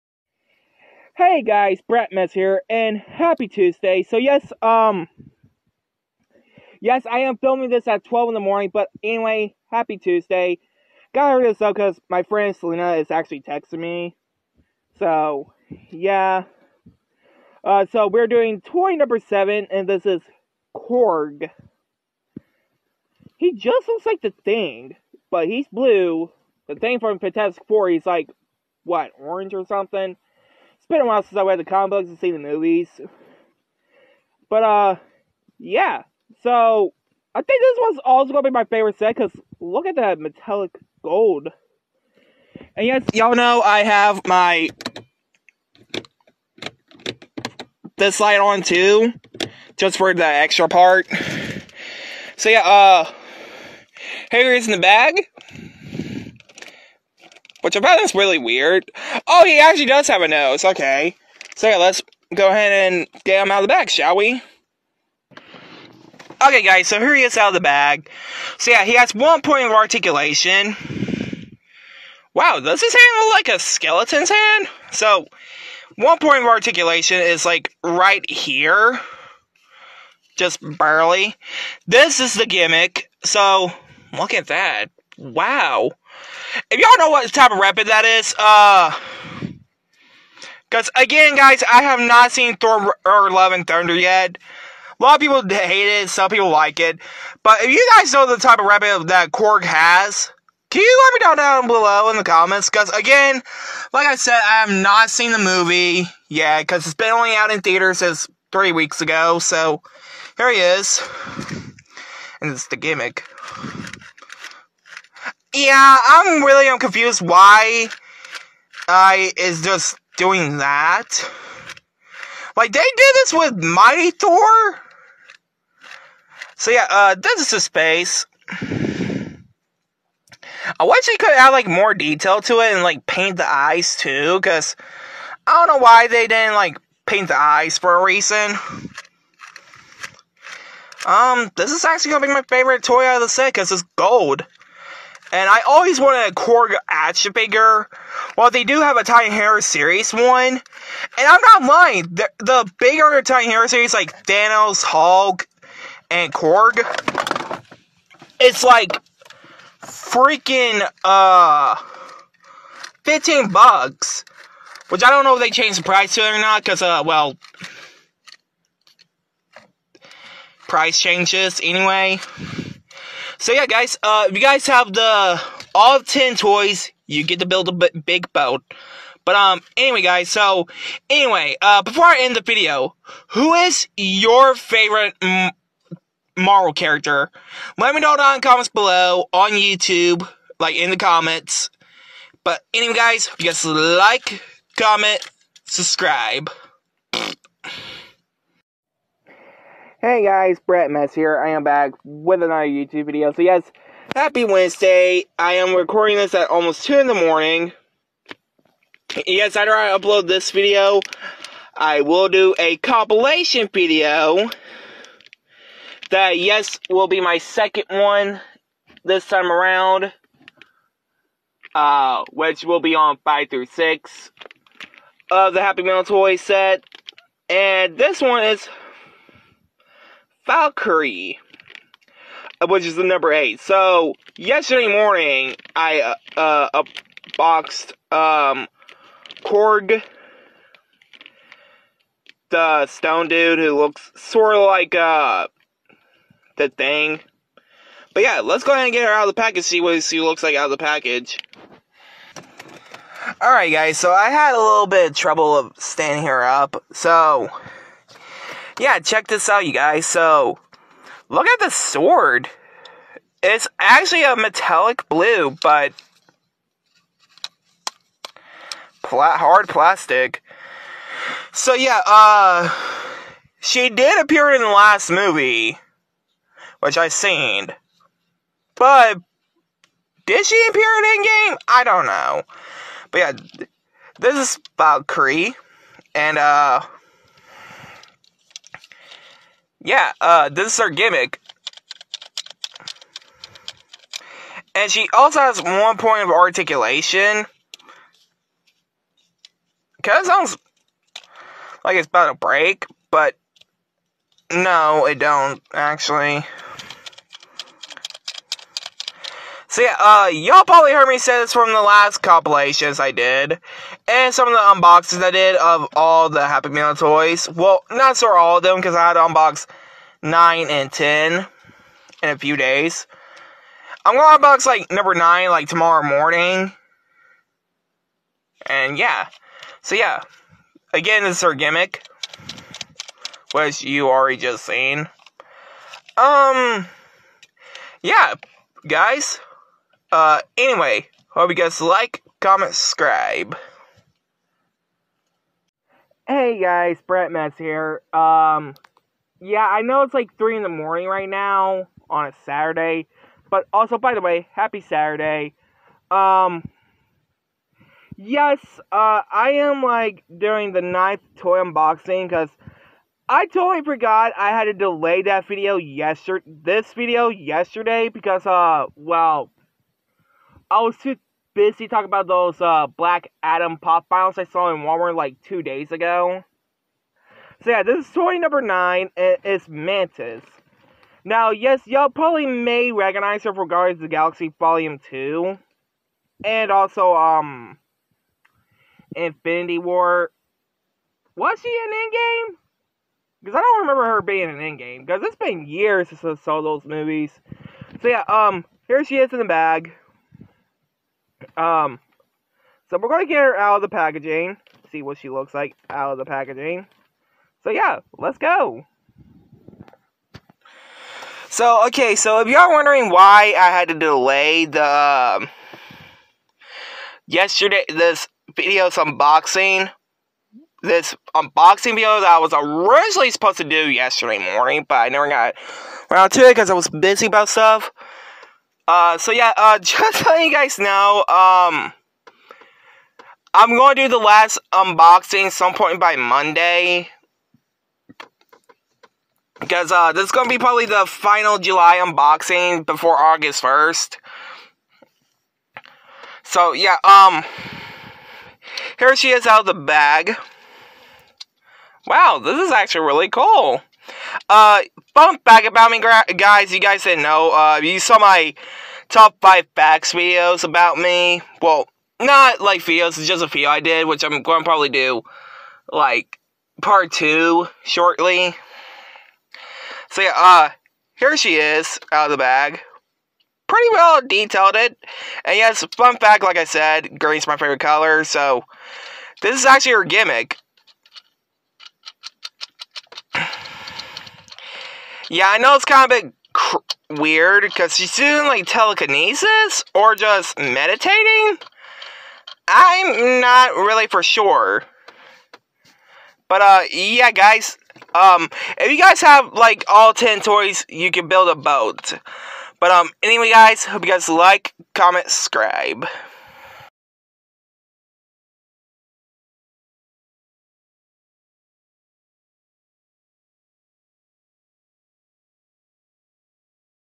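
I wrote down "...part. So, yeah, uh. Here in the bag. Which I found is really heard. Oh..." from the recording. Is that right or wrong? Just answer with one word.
wrong.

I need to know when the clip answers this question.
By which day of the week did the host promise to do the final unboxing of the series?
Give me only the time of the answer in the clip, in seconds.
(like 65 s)
436 s.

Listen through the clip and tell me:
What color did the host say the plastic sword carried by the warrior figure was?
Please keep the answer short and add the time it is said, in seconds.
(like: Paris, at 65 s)
metallic blue, at 264 s.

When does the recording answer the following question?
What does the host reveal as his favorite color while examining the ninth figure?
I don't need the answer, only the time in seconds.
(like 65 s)
477 s.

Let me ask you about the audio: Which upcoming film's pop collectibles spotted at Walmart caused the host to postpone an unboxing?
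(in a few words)
Black Adam.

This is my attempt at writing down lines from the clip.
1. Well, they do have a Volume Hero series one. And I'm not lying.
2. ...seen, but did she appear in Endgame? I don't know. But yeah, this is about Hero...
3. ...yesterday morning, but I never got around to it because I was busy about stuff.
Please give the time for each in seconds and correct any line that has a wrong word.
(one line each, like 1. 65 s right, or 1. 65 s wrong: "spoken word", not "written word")
1. 148 s wrong: "Titan", not "Volume"
2. 277 s wrong: "Kree", not "Hero"
3. 423 s right.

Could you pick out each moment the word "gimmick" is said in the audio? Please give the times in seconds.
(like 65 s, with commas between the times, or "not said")
82 s, 112 s, 290 s, 331 s, 480 s.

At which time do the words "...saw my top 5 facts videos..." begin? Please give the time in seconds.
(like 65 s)
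457 s.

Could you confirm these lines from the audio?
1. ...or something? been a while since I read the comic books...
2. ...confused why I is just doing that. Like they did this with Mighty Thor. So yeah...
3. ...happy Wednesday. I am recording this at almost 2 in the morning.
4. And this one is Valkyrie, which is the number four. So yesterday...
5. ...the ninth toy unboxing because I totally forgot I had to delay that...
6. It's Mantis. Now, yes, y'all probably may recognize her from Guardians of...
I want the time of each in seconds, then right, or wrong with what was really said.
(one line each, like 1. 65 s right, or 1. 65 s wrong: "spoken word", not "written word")
1. 29 s right
2. 116 s right
3. 204 s right
4. 227 s wrong: "eight", not "four"
5. 360 s right
6. 379 s right.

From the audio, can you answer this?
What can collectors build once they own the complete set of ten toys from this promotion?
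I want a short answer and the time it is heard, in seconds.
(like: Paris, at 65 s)
a big boat, at 177 s.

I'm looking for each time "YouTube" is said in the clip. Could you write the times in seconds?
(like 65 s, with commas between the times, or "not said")
189 s, 202 s.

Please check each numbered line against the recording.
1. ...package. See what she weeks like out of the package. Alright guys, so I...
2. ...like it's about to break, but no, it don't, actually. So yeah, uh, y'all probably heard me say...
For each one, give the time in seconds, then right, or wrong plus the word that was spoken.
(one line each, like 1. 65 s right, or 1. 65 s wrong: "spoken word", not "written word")
1. 249 s wrong: "looks", not "weeks"
2. 301 s right.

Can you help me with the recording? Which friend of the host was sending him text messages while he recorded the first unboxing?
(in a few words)
Selena.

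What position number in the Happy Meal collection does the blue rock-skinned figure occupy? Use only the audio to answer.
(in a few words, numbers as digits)
7.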